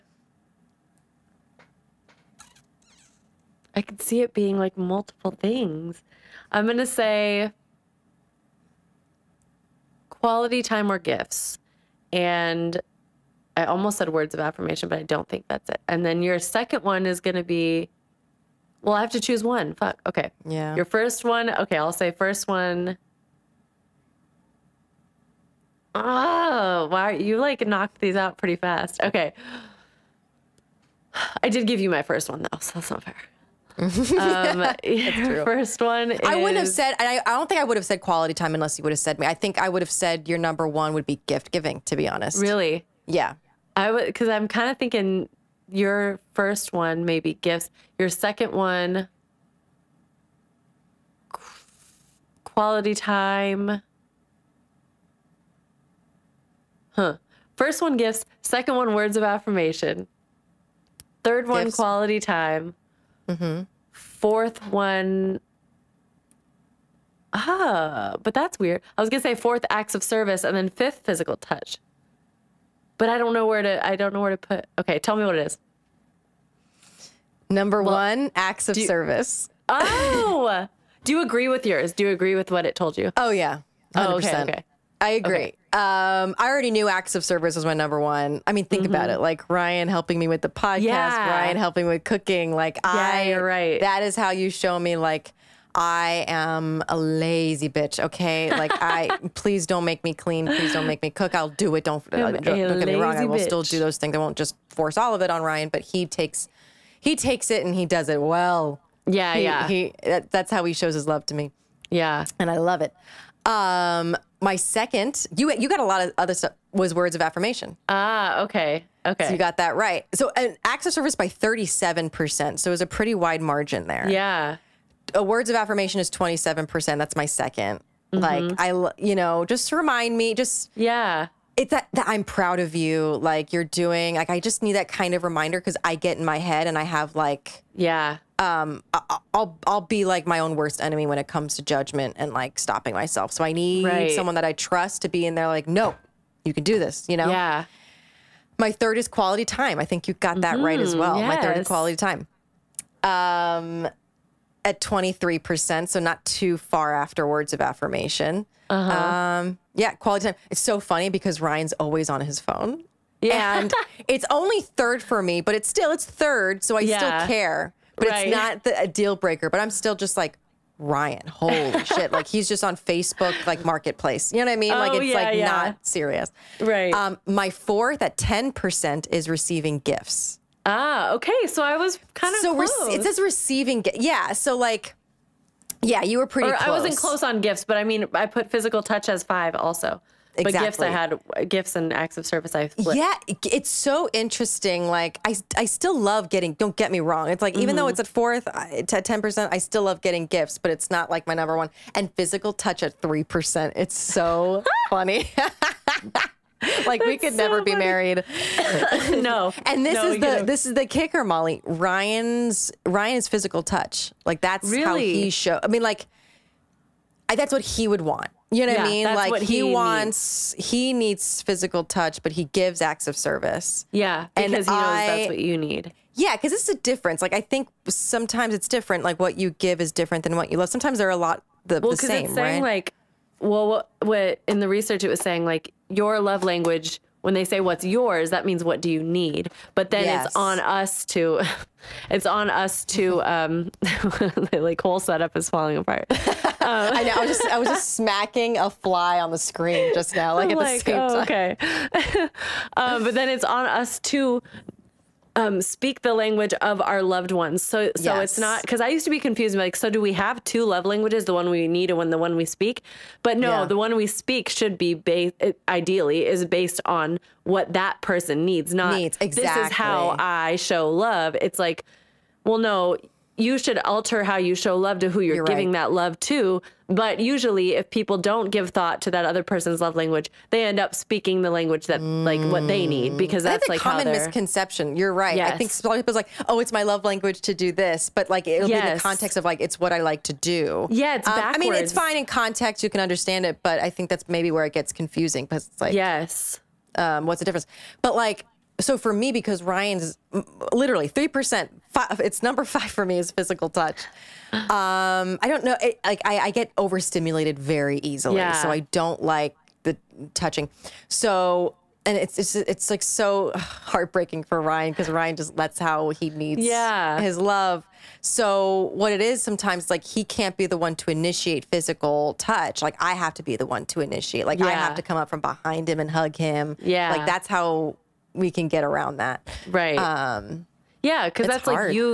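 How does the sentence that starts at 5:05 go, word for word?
It, like I, I, get overstimulated very easily, yeah.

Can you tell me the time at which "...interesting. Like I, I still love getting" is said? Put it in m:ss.
3:14.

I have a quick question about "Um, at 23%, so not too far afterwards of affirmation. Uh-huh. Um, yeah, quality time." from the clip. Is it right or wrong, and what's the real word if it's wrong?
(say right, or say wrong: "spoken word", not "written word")
right.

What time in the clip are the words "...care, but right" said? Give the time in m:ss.
2:47.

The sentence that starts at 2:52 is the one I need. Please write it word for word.
Like he's just on Facebook, like marketplace.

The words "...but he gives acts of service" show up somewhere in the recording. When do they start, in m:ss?
3:42.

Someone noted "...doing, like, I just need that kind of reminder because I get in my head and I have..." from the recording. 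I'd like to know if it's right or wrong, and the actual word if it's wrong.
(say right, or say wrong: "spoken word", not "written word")
right.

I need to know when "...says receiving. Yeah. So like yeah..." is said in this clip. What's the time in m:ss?
3:03.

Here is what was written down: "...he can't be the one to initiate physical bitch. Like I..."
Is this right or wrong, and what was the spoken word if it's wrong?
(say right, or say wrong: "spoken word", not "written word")
wrong: "touch", not "bitch".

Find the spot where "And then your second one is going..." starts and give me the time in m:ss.
0:15.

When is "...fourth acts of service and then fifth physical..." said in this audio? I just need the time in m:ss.
1:09.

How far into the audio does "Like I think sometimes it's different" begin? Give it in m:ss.
3:47.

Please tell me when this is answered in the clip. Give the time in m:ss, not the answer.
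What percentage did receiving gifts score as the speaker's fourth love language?
2:58.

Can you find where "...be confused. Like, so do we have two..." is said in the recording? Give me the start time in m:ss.
4:19.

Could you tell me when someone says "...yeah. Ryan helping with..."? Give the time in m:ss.
1:30.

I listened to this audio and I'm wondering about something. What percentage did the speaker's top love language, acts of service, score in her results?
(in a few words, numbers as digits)
37%.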